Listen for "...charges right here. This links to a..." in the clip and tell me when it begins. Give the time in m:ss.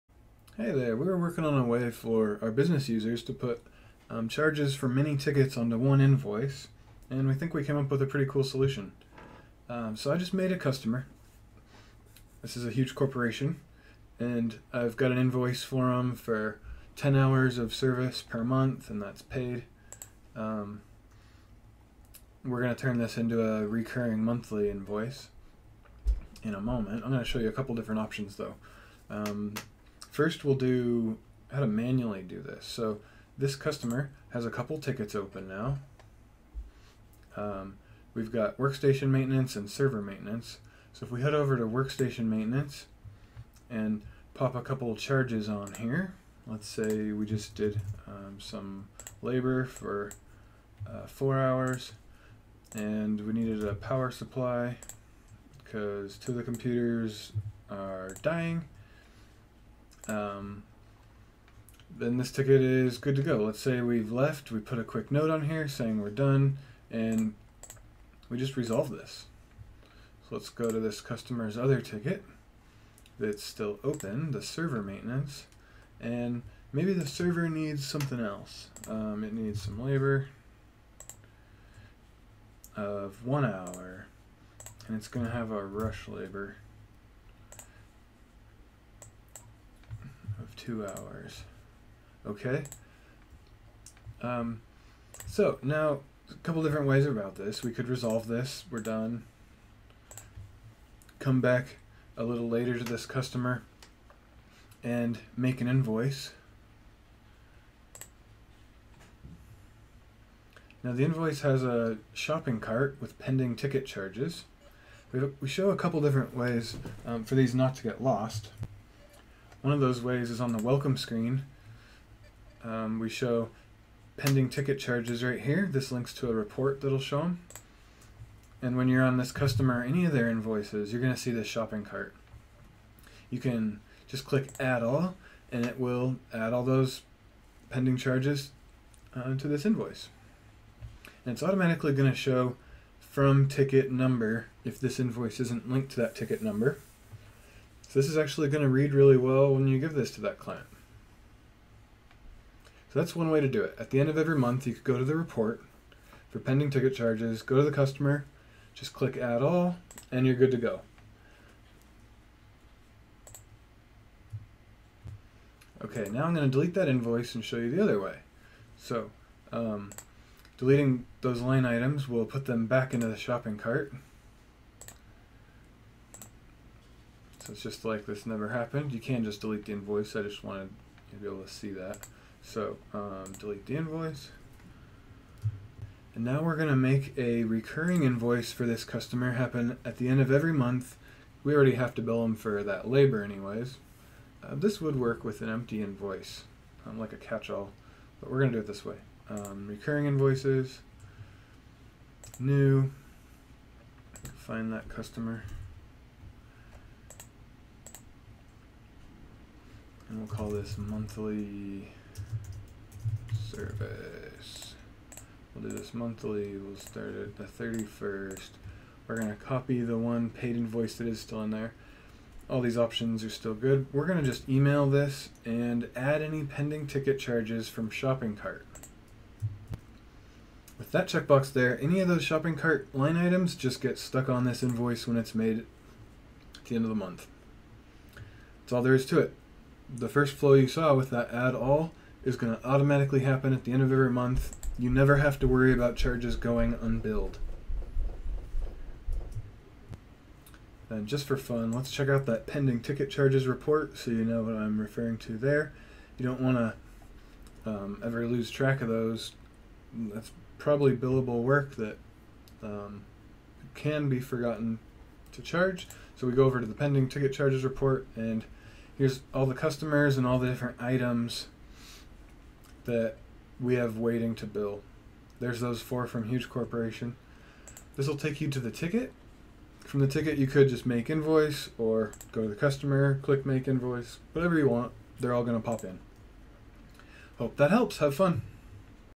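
2:04.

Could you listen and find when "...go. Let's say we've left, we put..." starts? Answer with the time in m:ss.
1:03.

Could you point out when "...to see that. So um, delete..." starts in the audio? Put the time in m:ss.
3:01.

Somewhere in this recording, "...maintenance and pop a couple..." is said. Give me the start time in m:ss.
0:42.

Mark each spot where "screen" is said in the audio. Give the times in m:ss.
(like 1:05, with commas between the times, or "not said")
2:00.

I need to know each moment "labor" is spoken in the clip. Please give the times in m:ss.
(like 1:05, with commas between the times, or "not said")
0:49, 1:19, 1:26, 3:12.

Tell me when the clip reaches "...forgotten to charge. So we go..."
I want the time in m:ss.
4:24.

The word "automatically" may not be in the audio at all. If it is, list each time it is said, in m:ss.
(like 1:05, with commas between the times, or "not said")
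2:21, 4:02.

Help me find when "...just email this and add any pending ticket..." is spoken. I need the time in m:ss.
3:44.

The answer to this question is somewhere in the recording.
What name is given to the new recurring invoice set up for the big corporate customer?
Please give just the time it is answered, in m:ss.
3:30.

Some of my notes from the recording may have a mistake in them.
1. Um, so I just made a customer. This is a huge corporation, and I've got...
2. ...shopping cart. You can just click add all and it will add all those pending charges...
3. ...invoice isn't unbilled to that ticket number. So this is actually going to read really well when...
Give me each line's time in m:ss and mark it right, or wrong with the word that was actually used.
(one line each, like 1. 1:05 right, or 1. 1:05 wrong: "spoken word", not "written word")
1. 0:09 right
2. 2:11 right
3. 2:24 wrong: "linked", not "unbilled".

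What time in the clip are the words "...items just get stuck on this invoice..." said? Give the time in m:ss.
3:53.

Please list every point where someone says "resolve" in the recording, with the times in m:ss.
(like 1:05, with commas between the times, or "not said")
1:08, 1:37.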